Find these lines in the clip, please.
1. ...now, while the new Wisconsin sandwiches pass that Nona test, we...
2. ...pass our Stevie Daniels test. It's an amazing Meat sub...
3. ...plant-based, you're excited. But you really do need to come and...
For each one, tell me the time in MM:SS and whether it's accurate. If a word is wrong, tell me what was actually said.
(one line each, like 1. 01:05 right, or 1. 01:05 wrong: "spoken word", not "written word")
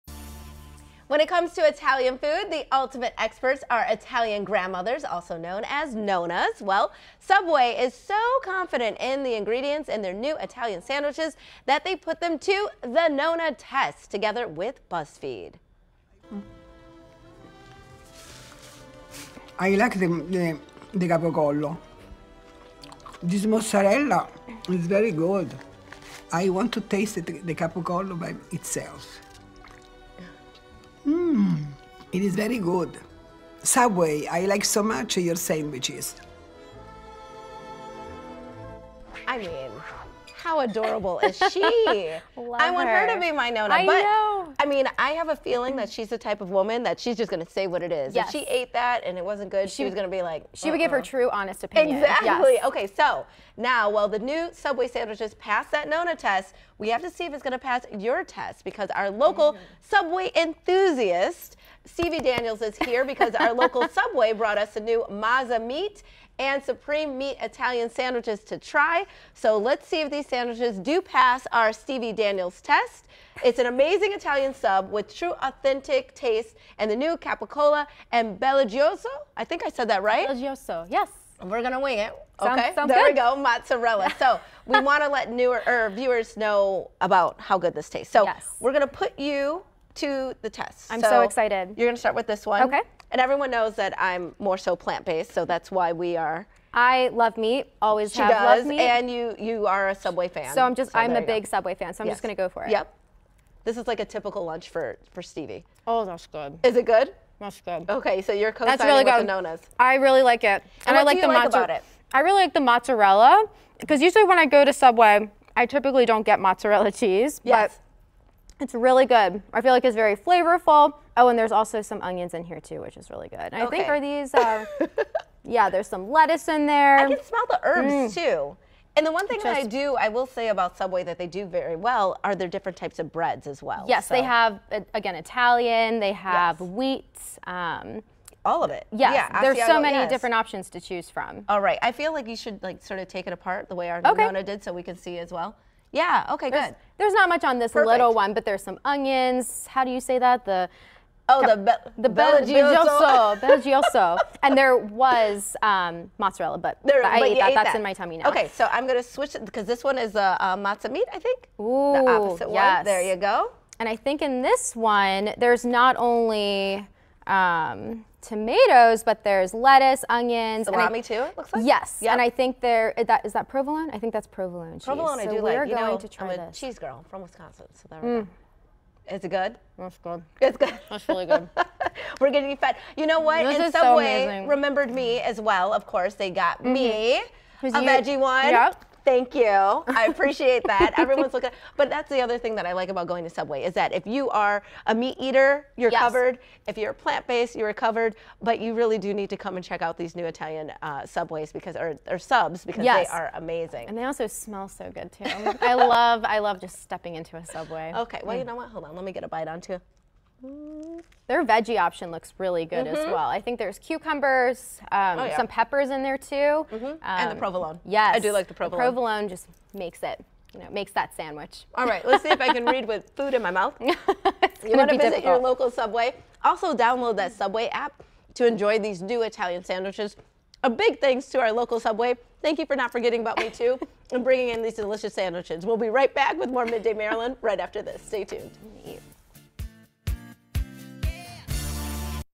1. 00:53 wrong: "Subway", not "Wisconsin"
2. 01:11 wrong: "Italian", not "Meat"
3. 03:16 wrong: "covered", not "excited".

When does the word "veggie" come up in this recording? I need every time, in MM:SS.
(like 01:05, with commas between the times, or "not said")
03:07, 03:31.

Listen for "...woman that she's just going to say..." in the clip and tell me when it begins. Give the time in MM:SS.
00:46.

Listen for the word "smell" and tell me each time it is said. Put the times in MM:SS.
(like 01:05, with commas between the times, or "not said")
02:07, 03:24.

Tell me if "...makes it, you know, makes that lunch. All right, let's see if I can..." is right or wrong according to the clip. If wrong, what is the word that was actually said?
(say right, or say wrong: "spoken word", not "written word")
wrong: "sandwich", not "lunch".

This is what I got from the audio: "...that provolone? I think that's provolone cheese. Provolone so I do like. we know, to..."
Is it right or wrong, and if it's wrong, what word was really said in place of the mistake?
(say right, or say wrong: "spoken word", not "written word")
right.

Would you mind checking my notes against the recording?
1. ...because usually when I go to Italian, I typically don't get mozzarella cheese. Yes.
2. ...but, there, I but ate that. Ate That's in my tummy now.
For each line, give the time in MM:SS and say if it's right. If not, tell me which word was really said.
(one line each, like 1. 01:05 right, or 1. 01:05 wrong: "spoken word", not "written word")
1. 01:53 wrong: "Subway", not "Italian"
2. 02:36 right.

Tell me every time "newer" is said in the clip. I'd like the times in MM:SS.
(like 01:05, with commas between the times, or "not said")
01:25.